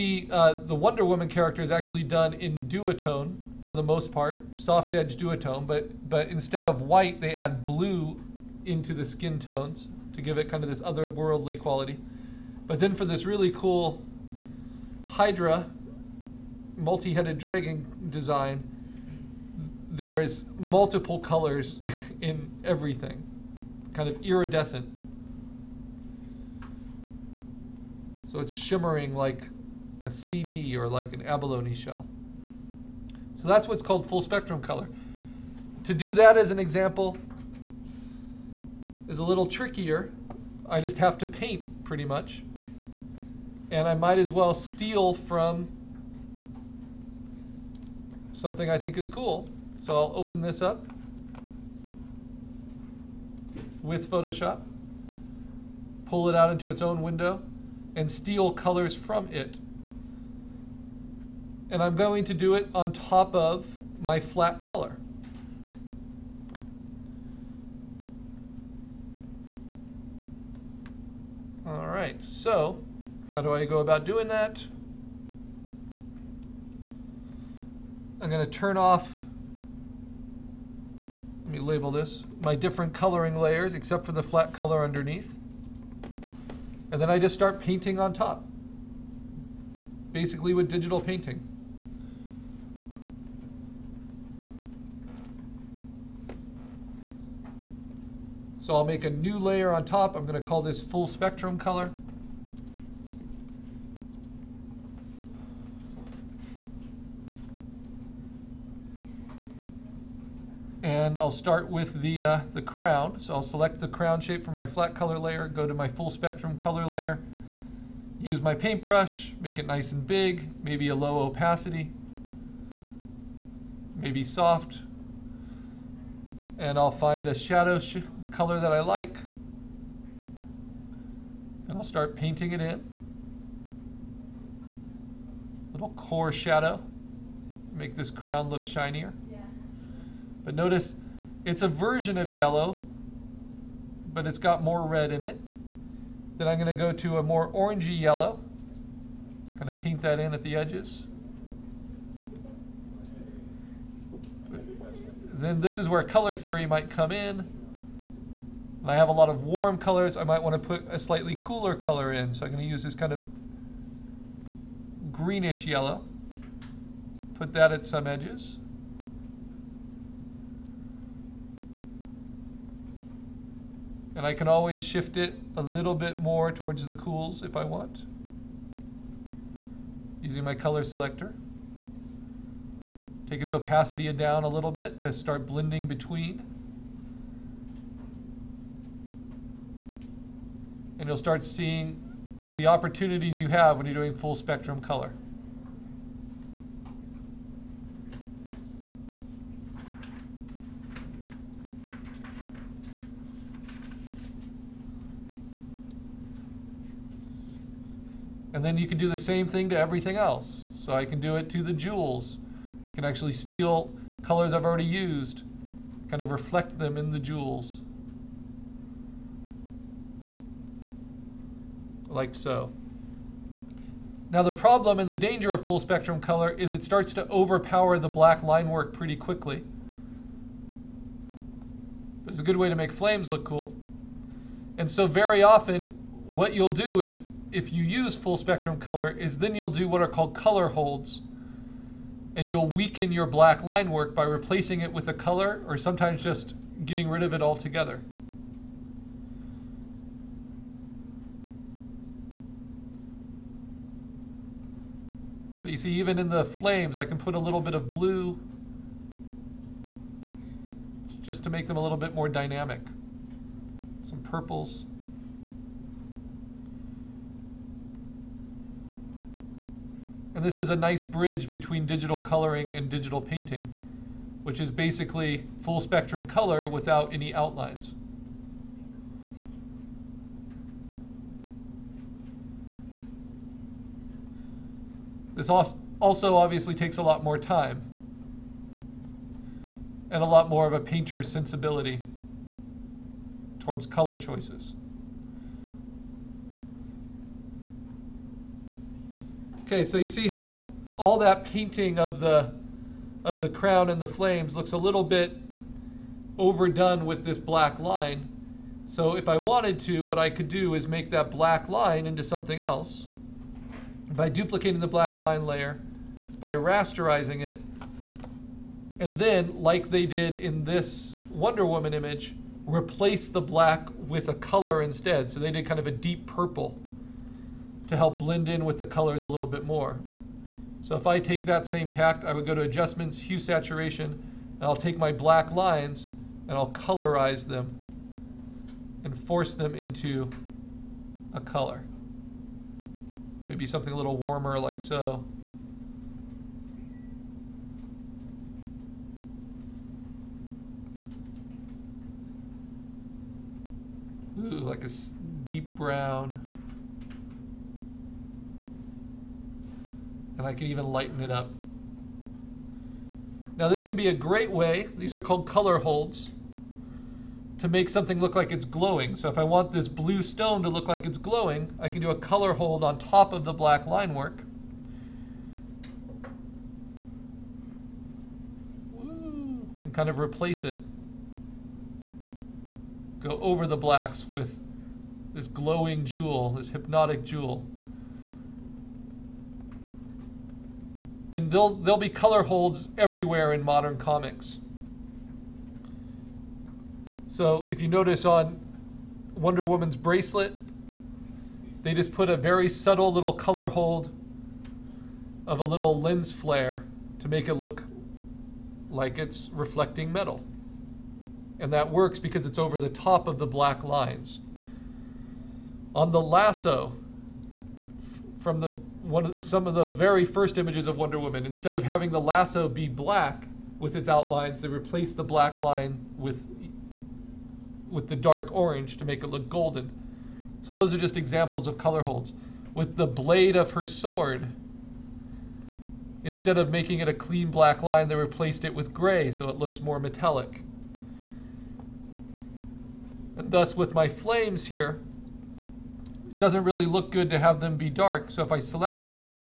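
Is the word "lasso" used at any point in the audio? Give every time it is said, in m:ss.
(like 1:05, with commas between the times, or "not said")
6:56, 7:02.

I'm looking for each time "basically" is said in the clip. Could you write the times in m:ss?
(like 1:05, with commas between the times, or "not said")
1:30, 4:34.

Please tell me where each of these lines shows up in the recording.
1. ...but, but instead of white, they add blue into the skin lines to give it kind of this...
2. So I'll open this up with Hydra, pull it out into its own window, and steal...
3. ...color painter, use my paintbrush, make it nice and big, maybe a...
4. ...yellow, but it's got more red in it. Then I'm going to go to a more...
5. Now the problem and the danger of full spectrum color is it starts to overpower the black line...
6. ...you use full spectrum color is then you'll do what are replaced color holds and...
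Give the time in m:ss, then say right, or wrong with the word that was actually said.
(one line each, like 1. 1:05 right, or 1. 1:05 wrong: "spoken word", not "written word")
1. 0:05 wrong: "tones", not "lines"
2. 0:49 wrong: "Photoshop", not "Hydra"
3. 1:56 wrong: "layer", not "painter"
4. 2:22 right
5. 3:44 right
6. 3:57 wrong: "called", not "replaced".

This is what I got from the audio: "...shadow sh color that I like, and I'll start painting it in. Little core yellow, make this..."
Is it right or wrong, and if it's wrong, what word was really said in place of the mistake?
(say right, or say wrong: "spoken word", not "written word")
wrong: "shadow", not "yellow".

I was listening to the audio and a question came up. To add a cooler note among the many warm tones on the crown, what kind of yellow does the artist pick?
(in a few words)
greenish yellow.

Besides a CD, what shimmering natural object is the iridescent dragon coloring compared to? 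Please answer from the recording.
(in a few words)
abalone shell.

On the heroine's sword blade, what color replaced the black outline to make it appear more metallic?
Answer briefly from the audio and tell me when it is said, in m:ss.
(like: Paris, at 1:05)
gray, at 7:18.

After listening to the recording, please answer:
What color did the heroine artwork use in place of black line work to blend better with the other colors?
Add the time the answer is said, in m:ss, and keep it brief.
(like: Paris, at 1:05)
deep purple, at 5:25.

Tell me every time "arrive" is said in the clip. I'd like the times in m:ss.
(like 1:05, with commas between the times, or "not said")
not said.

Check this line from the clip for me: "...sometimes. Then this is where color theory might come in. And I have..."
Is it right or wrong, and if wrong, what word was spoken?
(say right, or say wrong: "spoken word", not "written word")
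wrong: "edges", not "sometimes".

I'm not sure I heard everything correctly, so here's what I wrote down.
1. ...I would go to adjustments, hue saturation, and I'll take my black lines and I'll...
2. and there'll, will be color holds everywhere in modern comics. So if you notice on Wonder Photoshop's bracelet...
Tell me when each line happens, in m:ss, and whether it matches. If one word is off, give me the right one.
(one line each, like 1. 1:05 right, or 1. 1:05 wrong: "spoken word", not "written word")
1. 5:32 right
2. 6:31 wrong: "Woman", not "Photoshop".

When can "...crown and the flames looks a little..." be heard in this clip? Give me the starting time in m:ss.
5:03.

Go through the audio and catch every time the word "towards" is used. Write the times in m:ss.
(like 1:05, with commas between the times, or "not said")
2:56, 4:53.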